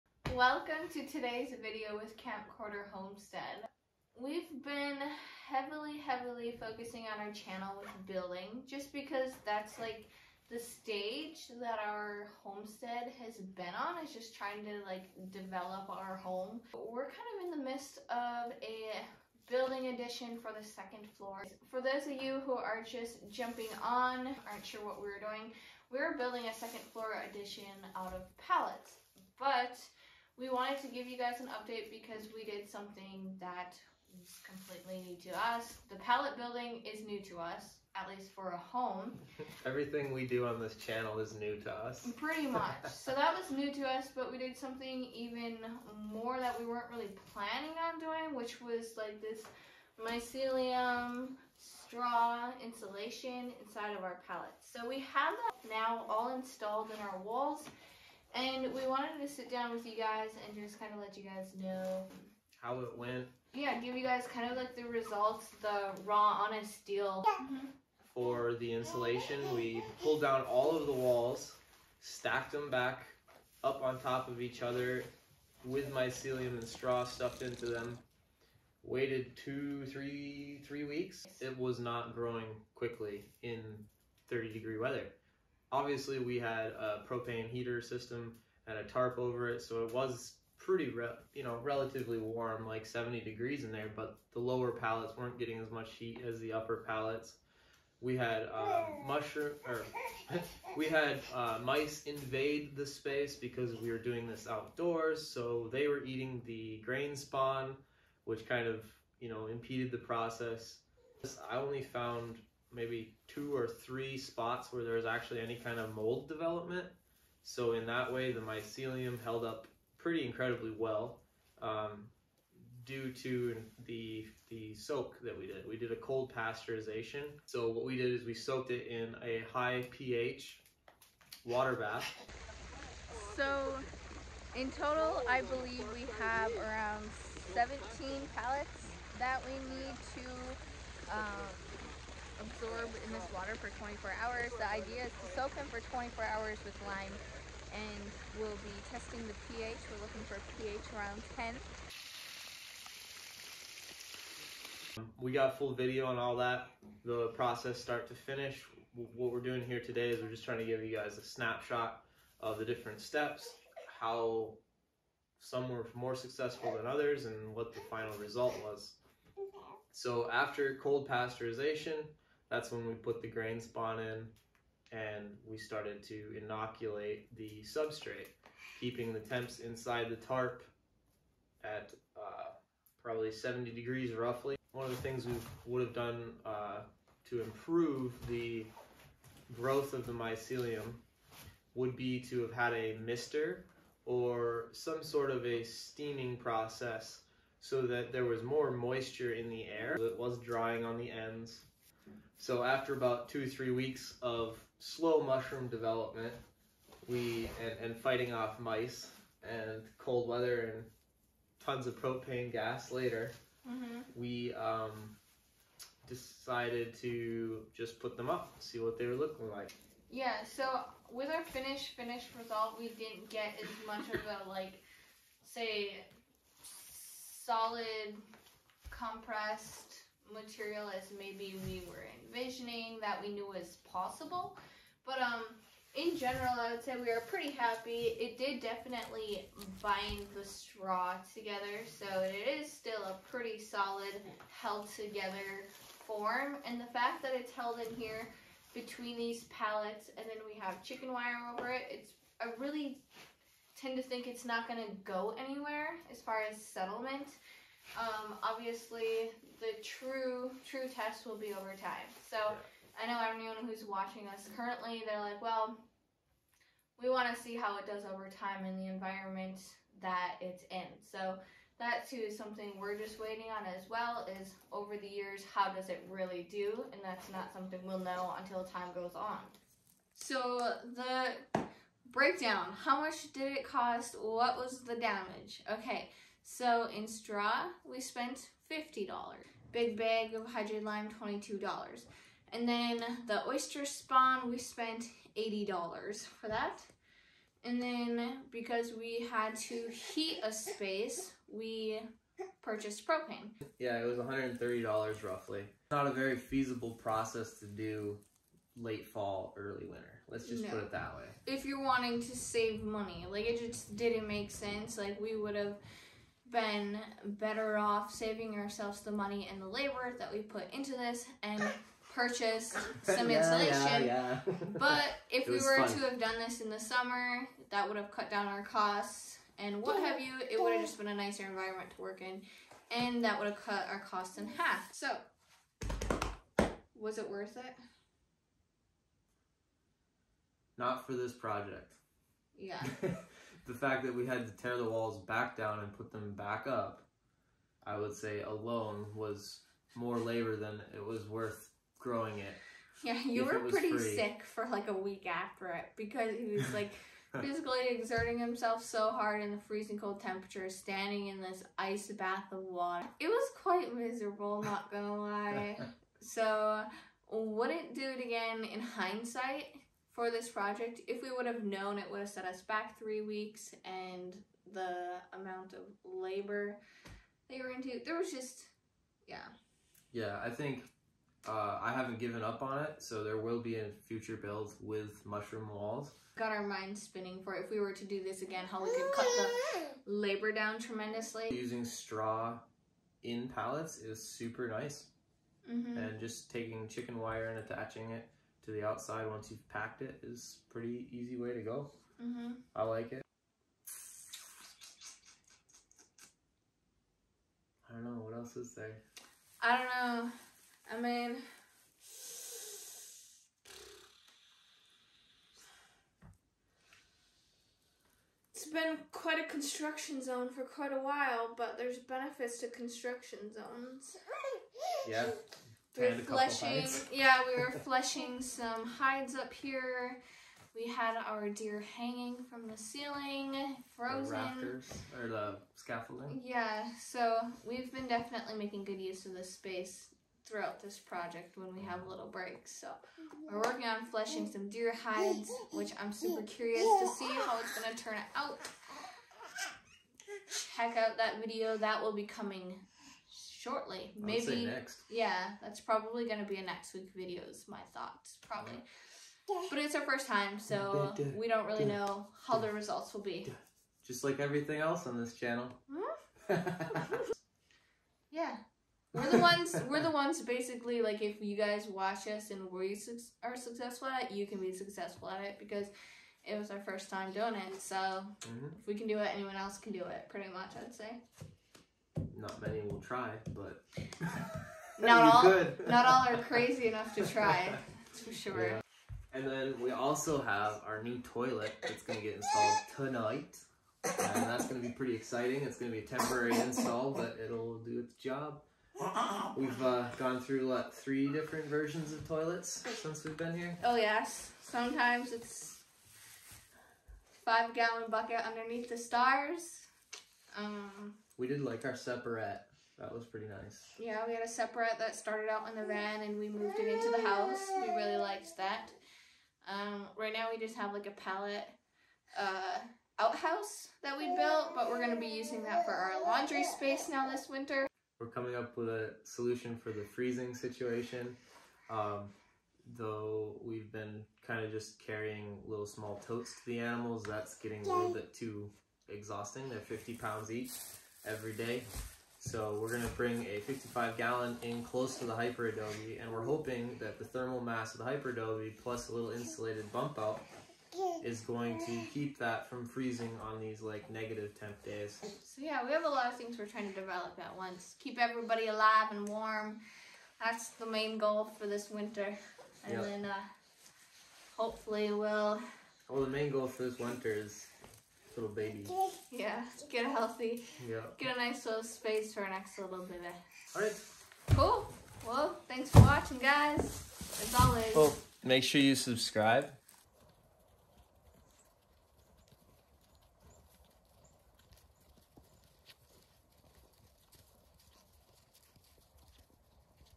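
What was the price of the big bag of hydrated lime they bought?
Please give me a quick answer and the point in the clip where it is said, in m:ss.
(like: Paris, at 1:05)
$22, at 4:51.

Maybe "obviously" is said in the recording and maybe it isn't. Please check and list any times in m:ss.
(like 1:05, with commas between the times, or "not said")
1:25, 4:18.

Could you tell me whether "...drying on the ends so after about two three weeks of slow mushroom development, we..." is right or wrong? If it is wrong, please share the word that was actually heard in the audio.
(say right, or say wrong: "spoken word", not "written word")
right.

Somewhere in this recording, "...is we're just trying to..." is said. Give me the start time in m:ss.
2:40.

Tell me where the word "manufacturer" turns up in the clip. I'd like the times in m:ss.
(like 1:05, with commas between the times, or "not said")
not said.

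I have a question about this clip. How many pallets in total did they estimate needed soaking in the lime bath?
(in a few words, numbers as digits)
17.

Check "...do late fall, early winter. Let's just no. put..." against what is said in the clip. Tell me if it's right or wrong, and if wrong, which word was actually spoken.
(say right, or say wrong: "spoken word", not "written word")
right.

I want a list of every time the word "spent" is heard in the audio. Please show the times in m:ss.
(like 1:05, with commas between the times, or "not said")
4:48, 4:54.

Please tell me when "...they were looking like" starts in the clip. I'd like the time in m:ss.
3:38.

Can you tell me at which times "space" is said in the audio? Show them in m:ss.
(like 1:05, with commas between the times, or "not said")
1:42, 5:00, 7:19, 8:46, 9:31.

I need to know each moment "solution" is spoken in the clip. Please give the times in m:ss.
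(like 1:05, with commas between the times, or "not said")
8:49.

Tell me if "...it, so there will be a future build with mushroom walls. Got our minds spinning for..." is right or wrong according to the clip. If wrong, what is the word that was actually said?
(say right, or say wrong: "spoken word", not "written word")
right.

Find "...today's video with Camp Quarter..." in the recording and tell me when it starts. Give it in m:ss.
0:01.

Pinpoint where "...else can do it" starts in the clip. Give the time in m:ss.
7:59.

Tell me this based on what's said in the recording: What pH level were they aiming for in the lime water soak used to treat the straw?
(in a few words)
10.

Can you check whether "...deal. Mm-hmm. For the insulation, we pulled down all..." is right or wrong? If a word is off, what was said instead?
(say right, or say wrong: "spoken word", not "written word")
right.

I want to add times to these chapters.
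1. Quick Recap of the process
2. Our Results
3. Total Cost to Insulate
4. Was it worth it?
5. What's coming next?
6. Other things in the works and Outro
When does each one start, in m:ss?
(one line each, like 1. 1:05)
1. 1:07
2. 3:04
3. 4:39
4. 5:35
5. 6:45
6. 8:09.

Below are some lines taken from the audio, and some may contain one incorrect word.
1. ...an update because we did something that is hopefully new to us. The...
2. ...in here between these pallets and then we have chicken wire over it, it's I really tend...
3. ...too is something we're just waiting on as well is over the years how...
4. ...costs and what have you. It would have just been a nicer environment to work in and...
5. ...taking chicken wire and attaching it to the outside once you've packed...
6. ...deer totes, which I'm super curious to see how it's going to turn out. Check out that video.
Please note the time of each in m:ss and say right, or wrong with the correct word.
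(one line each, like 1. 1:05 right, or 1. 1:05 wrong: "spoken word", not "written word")
1. 0:31 wrong: "completely", not "hopefully"
2. 4:07 right
3. 4:32 right
4. 5:28 right
5. 6:36 right
6. 7:24 wrong: "hides", not "totes".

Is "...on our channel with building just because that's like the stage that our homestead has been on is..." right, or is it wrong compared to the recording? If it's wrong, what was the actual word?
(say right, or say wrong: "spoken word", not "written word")
right.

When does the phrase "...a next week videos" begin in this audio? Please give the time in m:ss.
7:36.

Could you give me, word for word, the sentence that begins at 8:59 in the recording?
They're 50 pounds each every day.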